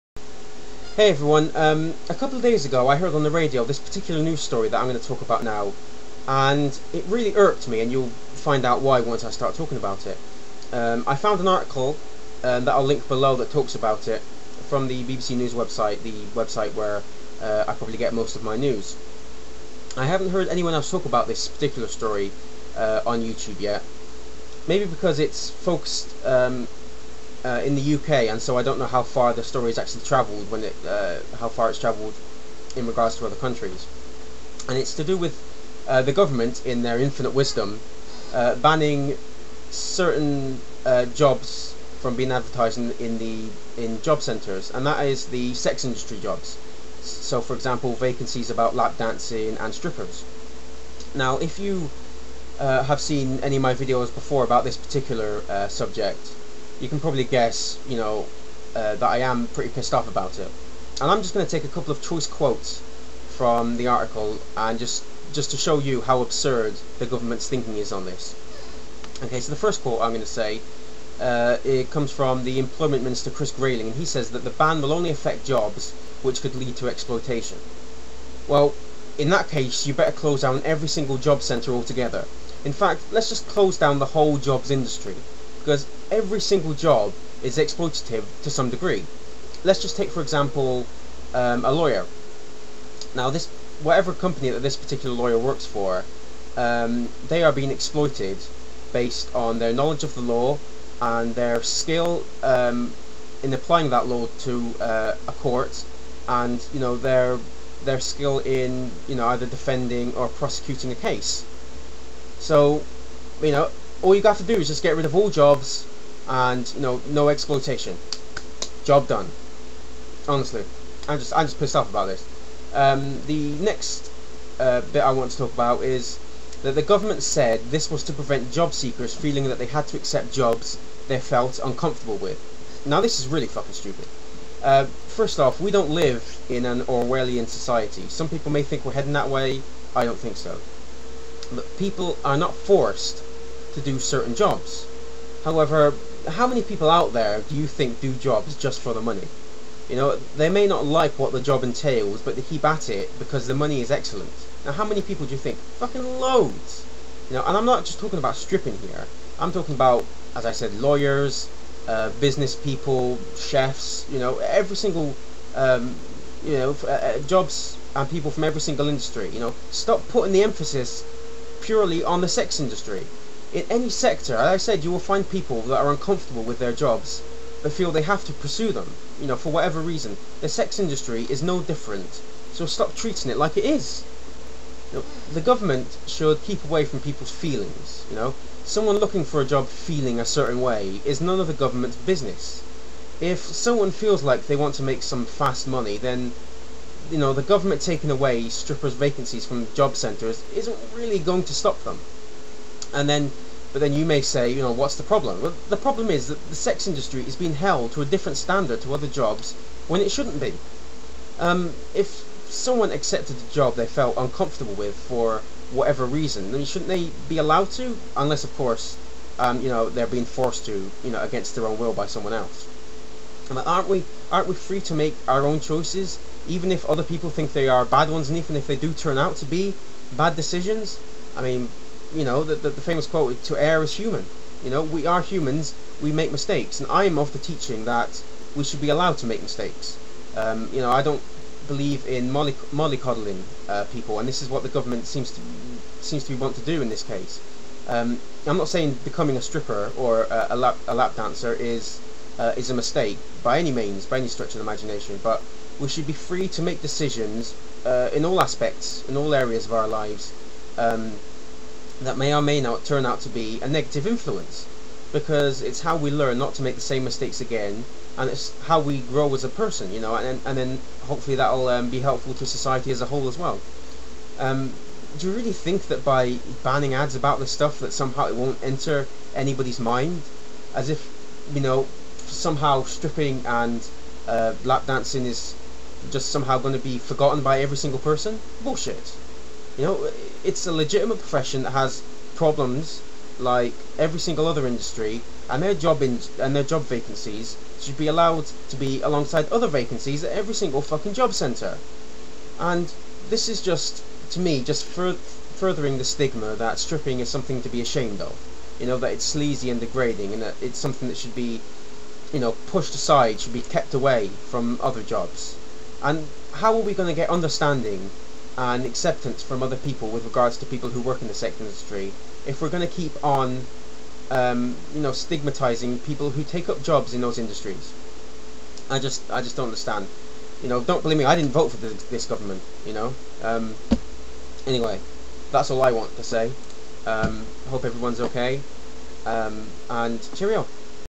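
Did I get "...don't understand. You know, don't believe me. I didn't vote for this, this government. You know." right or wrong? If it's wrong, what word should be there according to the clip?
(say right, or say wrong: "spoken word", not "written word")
right.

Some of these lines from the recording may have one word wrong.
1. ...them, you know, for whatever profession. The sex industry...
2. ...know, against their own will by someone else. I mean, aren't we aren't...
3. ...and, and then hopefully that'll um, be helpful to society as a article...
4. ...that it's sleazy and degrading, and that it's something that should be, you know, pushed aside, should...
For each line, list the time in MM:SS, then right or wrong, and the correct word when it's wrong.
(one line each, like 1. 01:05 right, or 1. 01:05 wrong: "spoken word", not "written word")
1. 02:58 wrong: "reason", not "profession"
2. 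03:41 right
3. 04:30 wrong: "whole", not "article"
4. 05:08 right.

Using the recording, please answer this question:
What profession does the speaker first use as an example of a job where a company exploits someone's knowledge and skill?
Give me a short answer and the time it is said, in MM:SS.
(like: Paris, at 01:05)
A lawyer, at 01:31.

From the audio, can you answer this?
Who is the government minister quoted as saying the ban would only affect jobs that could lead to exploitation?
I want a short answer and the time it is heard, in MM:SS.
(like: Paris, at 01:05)
Chris Grayling, at 01:13.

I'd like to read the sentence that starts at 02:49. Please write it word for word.
You know, stop putting the emphasis purely on the sex industry.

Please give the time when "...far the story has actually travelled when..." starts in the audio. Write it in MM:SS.
00:29.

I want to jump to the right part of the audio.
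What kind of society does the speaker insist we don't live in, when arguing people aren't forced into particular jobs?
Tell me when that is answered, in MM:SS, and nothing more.
02:16.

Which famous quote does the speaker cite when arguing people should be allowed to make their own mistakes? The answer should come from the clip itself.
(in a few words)
To err is human.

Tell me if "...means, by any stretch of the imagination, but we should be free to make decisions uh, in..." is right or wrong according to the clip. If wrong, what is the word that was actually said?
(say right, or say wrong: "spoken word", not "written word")
right.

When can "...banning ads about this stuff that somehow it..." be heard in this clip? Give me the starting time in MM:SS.
04:36.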